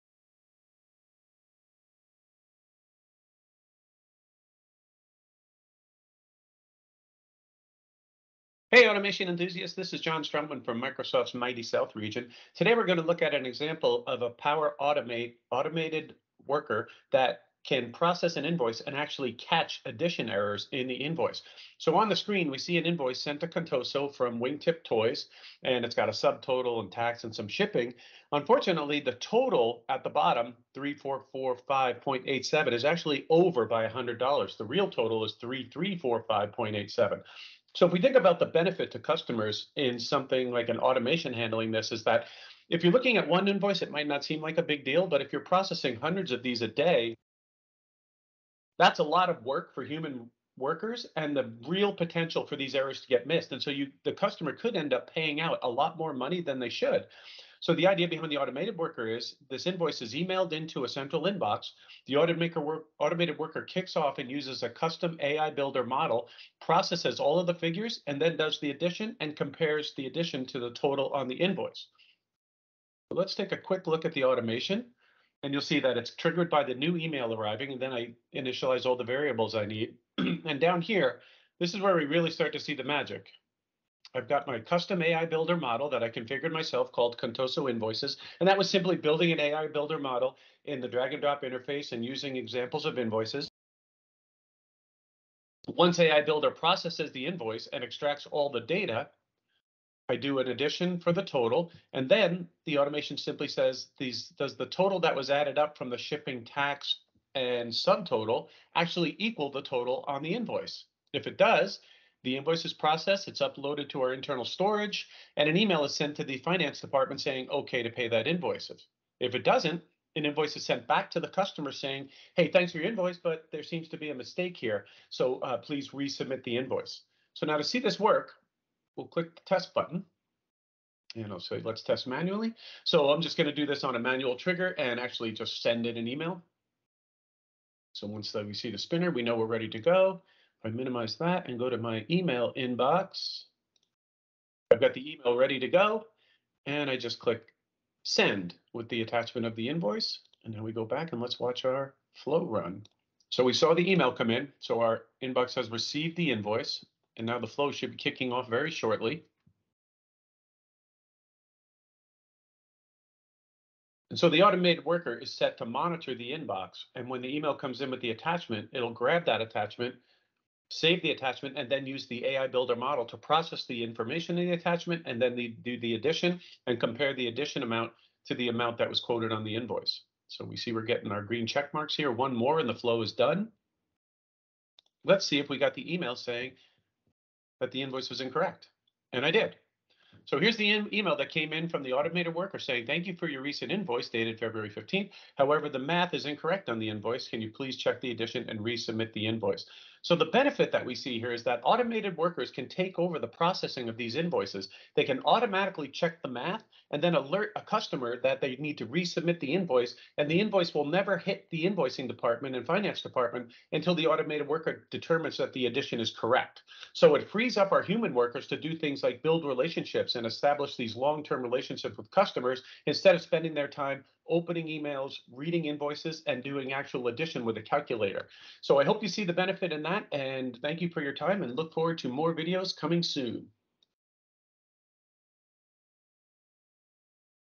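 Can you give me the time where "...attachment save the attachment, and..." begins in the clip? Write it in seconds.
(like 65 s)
169 s.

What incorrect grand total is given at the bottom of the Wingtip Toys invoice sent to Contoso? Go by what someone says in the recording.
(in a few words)
3445.87.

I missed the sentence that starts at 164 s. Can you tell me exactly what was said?
And so the automated worker is set to monitor the inbox.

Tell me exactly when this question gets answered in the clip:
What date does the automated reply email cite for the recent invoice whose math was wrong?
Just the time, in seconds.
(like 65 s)
194 s.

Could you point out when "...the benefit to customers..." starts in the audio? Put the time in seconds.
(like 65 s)
38 s.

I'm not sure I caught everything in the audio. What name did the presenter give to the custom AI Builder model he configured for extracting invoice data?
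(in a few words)
Contoso Invoices.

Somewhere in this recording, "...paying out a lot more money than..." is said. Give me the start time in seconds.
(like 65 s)
55 s.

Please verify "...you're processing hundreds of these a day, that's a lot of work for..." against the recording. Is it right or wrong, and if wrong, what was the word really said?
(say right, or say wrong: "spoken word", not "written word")
right.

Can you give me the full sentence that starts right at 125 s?
So uh, please resubmit the invoice.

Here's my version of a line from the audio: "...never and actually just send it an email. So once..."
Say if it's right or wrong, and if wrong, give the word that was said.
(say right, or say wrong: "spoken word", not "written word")
wrong: "trigger", not "never".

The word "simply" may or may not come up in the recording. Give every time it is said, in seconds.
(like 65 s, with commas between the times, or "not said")
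88 s, 103 s.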